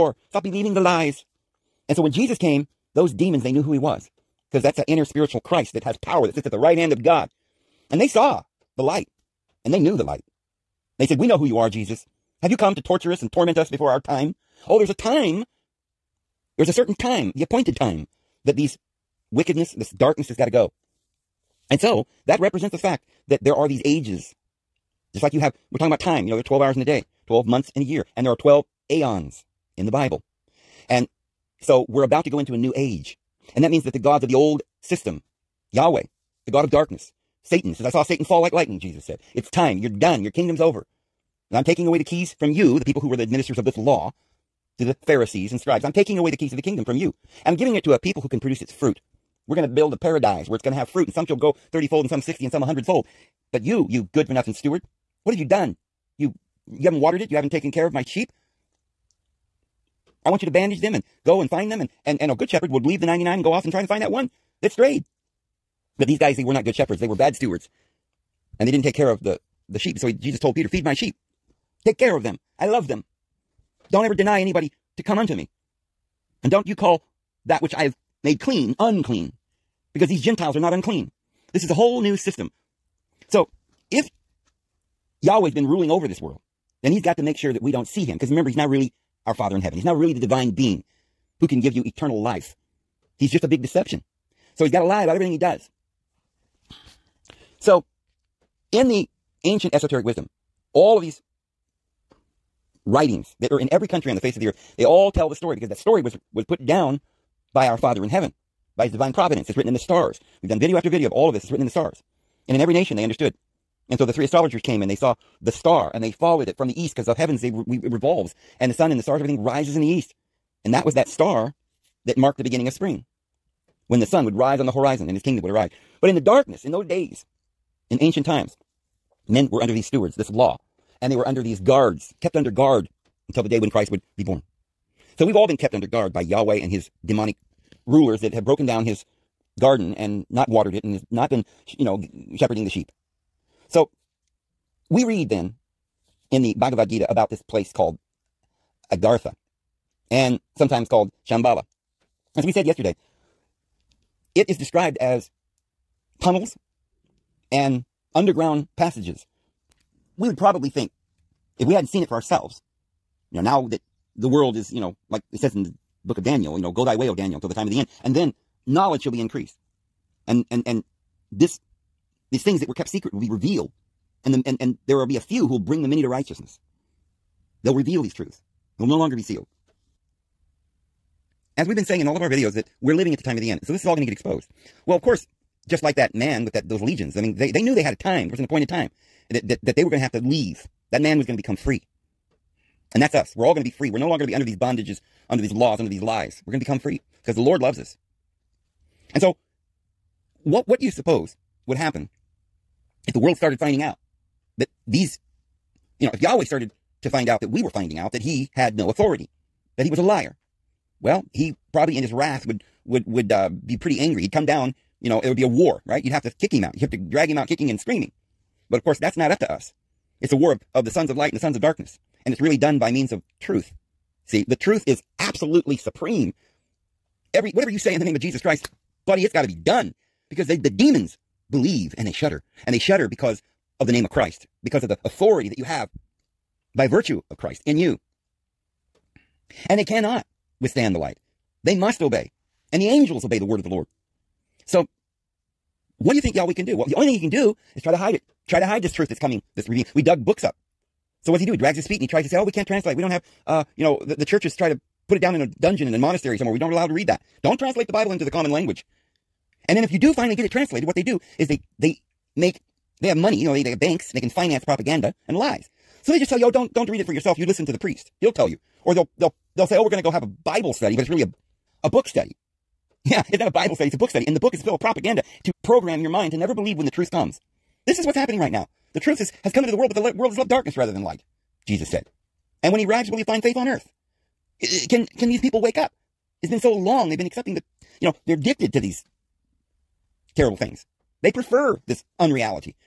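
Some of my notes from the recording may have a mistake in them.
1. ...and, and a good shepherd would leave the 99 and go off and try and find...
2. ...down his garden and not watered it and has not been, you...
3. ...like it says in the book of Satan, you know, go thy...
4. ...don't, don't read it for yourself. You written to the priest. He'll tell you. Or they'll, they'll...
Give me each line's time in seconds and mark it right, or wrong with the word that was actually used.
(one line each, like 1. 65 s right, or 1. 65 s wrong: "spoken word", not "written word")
1. 62 s right
2. 138 s right
3. 165 s wrong: "Daniel", not "Satan"
4. 266 s wrong: "listen", not "written".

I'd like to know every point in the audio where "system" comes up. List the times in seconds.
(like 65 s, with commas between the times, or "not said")
34 s, 82 s.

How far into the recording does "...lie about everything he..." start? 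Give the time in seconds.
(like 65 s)
94 s.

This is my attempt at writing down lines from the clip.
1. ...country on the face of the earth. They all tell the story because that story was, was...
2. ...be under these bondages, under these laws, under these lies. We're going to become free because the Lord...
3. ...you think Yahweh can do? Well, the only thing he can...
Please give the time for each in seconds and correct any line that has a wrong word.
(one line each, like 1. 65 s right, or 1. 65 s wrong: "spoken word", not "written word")
1. 103 s right
2. 194 s right
3. 246 s right.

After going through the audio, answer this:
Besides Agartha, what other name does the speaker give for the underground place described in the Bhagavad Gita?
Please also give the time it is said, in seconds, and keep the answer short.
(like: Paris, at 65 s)
Shambhala, at 151 s.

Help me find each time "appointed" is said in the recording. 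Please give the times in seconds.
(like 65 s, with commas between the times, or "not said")
17 s, 188 s.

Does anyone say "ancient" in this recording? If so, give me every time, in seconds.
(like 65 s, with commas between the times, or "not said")
99 s, 127 s.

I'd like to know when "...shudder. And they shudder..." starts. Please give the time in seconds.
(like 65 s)
232 s.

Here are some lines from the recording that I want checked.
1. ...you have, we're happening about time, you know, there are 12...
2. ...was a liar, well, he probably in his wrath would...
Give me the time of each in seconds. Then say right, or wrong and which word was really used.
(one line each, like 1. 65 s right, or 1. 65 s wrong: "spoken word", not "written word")
1. 25 s wrong: "talking", not "happening"
2. 209 s right.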